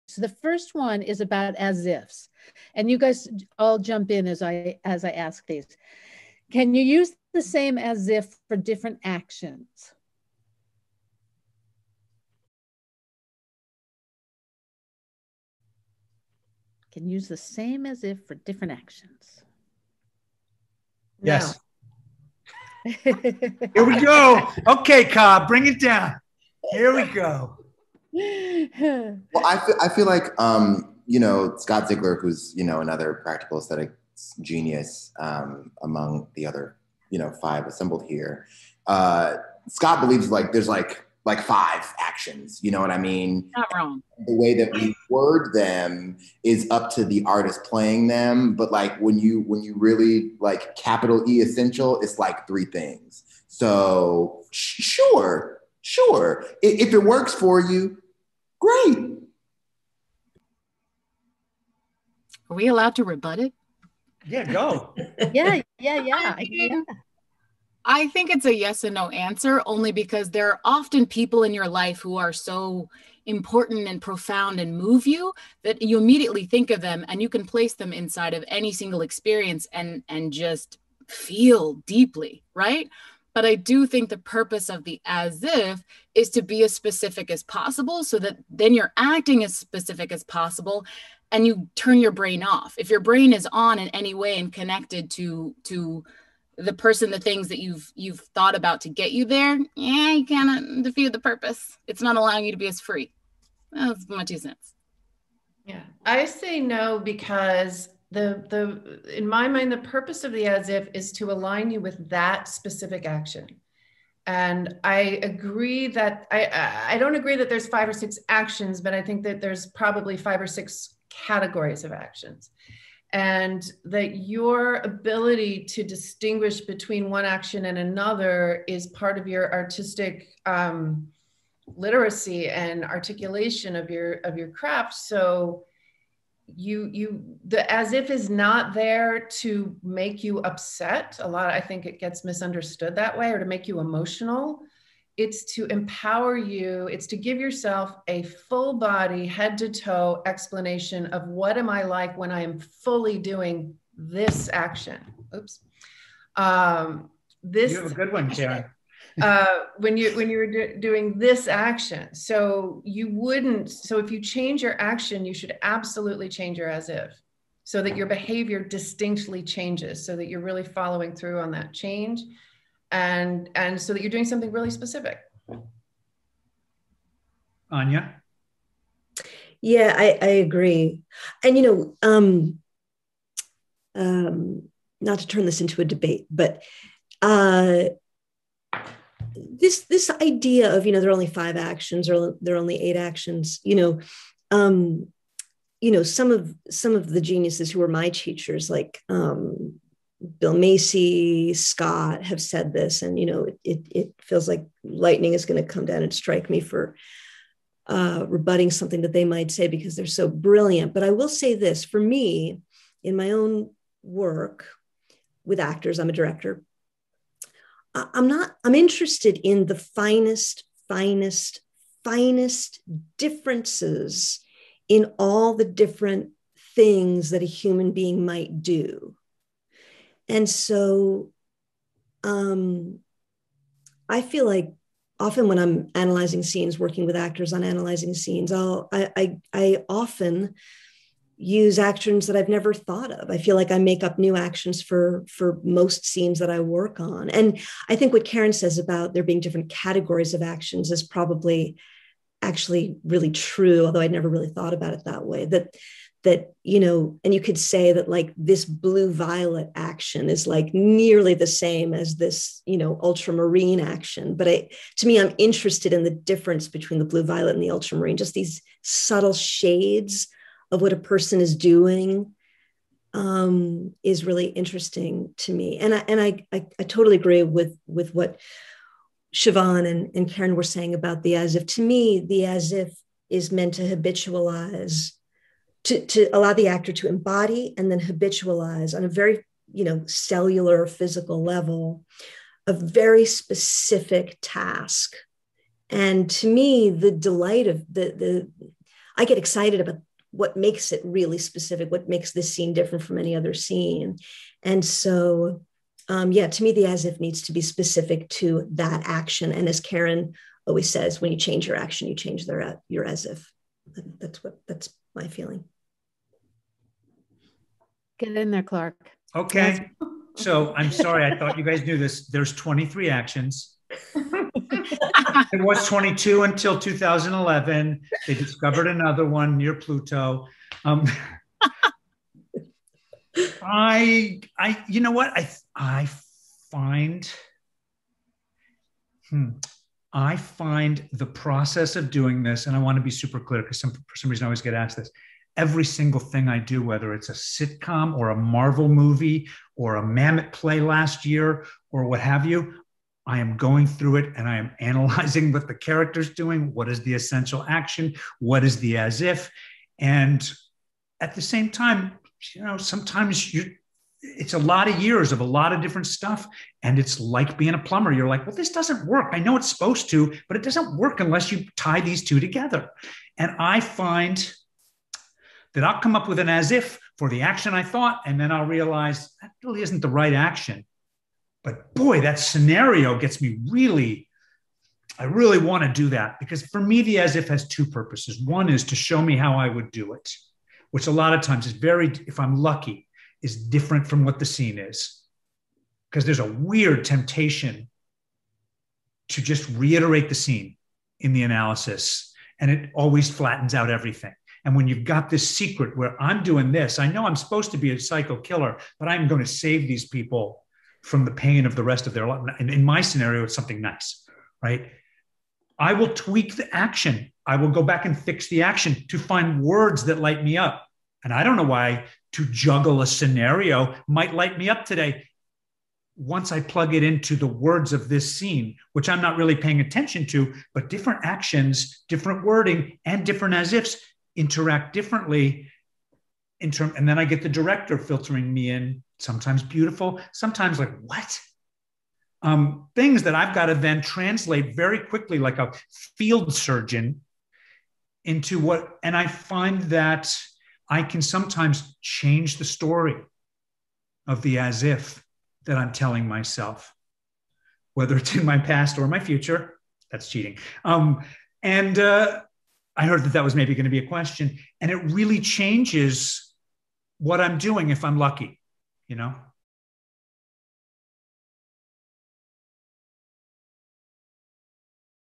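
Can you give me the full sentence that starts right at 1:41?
It's not allowing you to be as free.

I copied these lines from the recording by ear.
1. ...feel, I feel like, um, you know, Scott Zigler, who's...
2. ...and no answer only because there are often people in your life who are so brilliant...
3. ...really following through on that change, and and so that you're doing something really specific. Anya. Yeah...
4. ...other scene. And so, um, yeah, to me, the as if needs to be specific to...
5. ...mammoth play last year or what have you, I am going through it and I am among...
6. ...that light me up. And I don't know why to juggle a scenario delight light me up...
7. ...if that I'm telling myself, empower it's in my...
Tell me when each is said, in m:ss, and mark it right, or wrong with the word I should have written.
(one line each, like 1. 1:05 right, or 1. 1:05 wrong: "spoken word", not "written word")
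1. 0:29 right
2. 1:08 wrong: "important", not "brilliant"
3. 2:50 right
4. 5:03 right
5. 5:50 wrong: "analyzing", not "among"
6. 7:00 wrong: "might", not "delight"
7. 7:34 wrong: "whether", not "empower".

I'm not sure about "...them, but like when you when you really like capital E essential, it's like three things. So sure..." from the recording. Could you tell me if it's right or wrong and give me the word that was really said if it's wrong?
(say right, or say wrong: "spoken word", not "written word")
right.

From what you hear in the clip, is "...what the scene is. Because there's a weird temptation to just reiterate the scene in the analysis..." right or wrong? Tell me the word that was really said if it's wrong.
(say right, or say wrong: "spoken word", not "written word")
right.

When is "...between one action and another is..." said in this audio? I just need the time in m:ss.
2:06.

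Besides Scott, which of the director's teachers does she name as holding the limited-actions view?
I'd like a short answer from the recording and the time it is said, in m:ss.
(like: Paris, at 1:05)
Bill Macy, at 3:20.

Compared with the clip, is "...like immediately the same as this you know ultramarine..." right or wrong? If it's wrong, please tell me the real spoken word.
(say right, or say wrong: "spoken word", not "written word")
wrong: "nearly", not "immediately".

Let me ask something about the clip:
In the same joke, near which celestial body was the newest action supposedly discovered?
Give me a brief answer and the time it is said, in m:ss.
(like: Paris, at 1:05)
Pluto, at 5:29.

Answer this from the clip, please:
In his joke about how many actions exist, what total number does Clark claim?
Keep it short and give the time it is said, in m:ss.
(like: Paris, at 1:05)
23, at 5:22.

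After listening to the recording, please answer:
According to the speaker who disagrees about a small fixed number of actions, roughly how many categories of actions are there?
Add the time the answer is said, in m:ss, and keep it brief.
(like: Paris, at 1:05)
5 or 6, at 2:00.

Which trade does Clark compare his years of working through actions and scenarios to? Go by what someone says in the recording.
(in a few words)
Plumber.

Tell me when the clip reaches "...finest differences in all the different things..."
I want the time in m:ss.
3:42.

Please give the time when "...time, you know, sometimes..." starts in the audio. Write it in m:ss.
6:01.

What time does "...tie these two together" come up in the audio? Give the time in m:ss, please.
6:11.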